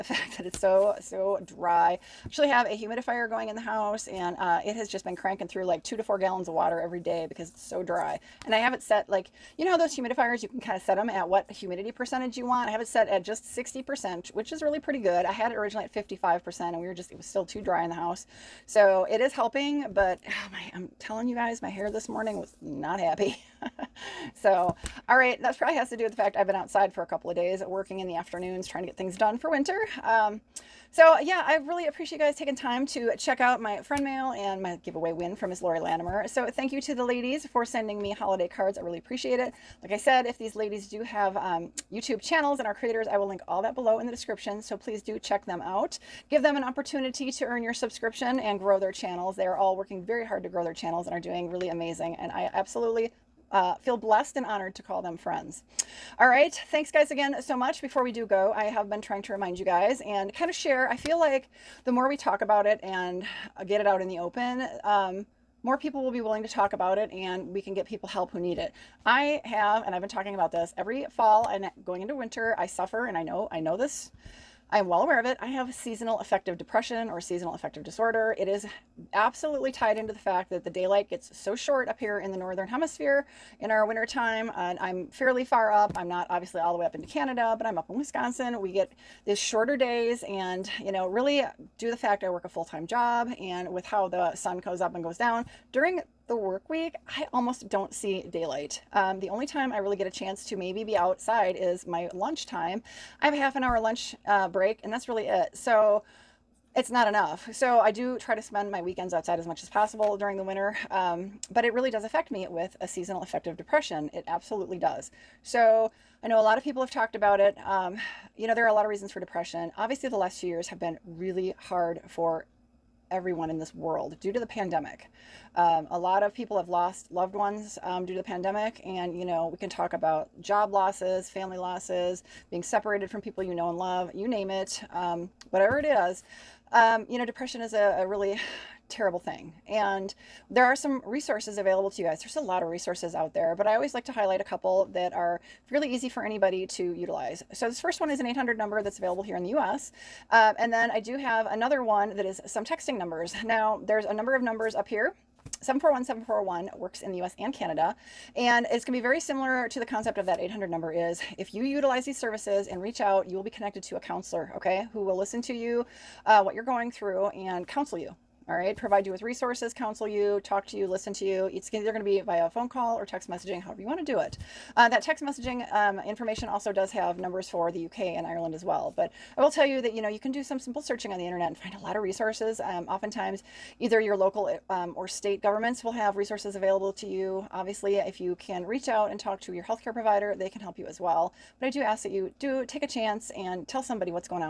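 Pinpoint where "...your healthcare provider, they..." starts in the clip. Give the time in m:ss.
3:09.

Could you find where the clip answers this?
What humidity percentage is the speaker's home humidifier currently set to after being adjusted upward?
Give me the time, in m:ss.
0:13.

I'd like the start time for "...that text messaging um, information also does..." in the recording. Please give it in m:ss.
2:54.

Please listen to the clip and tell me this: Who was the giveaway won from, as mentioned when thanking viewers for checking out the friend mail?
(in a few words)
Laurie Latimer.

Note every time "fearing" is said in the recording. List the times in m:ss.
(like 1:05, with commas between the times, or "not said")
not said.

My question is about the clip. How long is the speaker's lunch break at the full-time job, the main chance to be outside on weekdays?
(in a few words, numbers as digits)
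half an hour.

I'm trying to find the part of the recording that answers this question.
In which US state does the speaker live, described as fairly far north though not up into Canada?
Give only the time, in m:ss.
1:27.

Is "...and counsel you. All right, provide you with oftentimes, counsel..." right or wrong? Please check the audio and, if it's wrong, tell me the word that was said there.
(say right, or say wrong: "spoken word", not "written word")
wrong: "resources", not "oftentimes".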